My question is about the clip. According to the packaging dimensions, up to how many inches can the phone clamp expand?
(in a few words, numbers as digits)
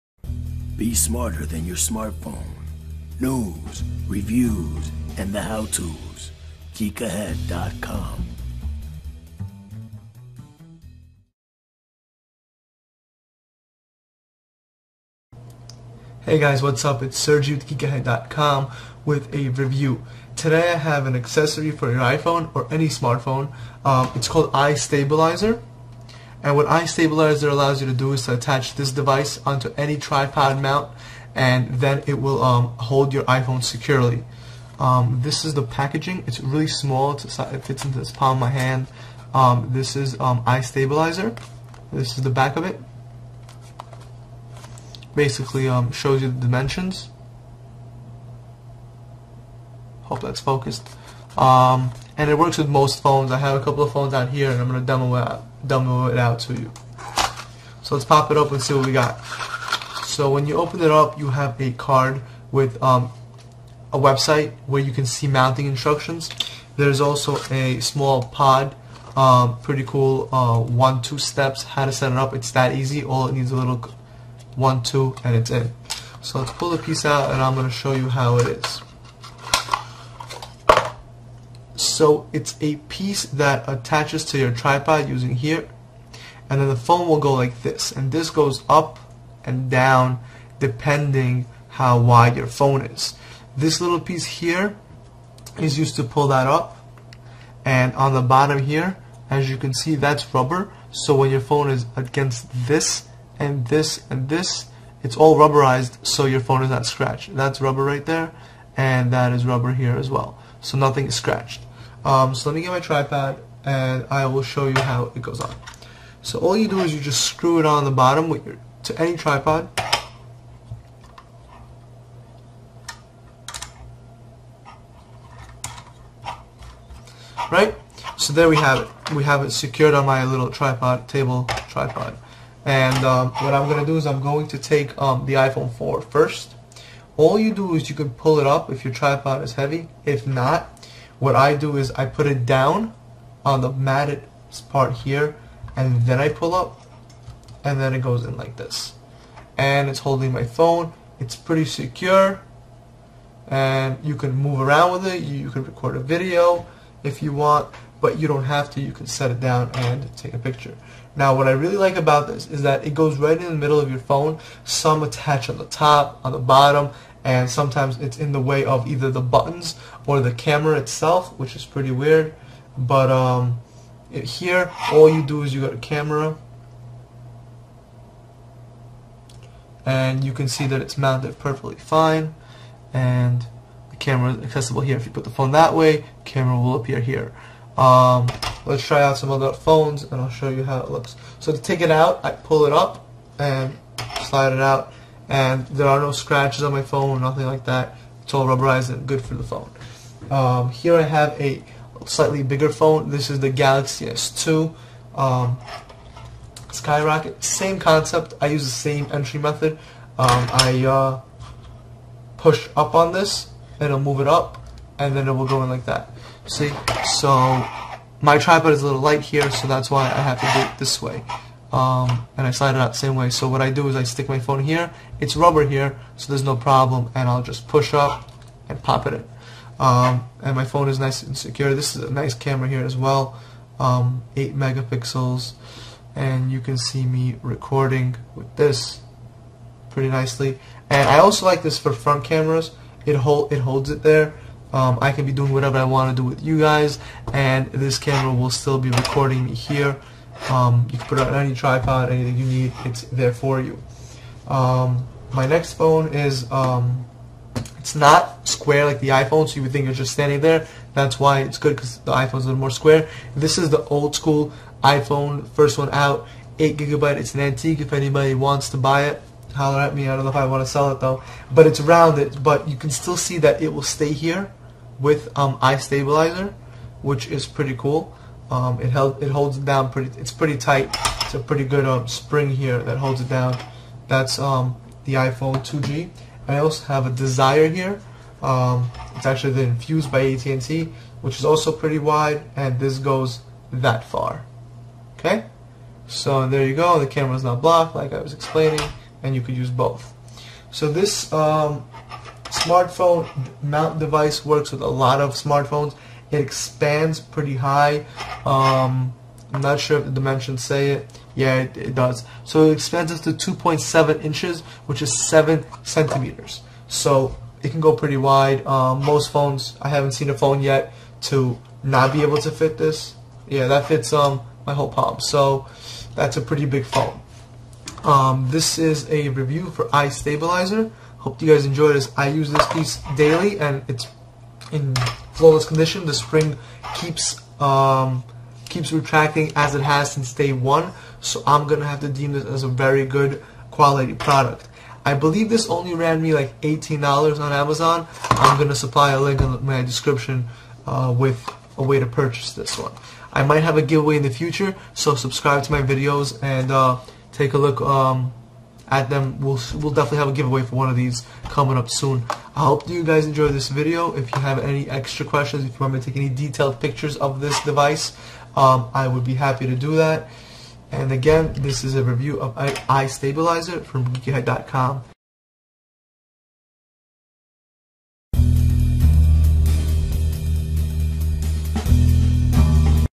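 2.7 inches.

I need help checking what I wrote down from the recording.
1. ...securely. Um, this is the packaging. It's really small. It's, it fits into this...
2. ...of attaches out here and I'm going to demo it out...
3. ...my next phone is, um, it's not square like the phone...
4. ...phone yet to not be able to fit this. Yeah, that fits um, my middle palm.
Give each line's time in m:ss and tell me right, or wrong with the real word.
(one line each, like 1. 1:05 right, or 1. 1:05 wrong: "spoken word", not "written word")
1. 0:33 right
2. 0:53 wrong: "phones", not "attaches"
3. 4:15 wrong: "iPhone", not "phone"
4. 5:20 wrong: "whole", not "middle".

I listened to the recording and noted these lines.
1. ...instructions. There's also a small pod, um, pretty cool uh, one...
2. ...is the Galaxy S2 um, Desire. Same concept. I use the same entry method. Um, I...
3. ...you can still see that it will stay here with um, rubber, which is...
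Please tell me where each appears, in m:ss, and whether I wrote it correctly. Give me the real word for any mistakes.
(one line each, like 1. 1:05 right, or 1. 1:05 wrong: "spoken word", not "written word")
1. 1:05 right
2. 3:23 wrong: "Skyrocket", not "Desire"
3. 4:32 wrong: "iStabilizer", not "rubber".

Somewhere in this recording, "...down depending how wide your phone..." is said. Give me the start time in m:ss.
1:29.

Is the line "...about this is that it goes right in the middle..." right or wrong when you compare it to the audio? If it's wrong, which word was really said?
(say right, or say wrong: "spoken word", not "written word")
right.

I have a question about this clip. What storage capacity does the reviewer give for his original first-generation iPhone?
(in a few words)
8 gigabyte.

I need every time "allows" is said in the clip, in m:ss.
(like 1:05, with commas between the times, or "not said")
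0:27.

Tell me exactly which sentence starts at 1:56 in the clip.
So all you do is you just screw it on the bottom with your to any tripod.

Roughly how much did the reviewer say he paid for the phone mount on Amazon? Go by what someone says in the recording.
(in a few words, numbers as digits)
$18.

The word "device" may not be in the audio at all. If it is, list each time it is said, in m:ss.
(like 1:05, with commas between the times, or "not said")
0:28, 5:03, 6:07.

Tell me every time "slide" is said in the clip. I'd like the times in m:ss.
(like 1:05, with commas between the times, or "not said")
3:14, 3:42.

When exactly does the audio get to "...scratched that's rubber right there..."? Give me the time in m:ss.
1:46.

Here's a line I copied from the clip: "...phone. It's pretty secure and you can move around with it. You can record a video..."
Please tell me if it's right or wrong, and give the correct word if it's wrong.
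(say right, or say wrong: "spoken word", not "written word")
right.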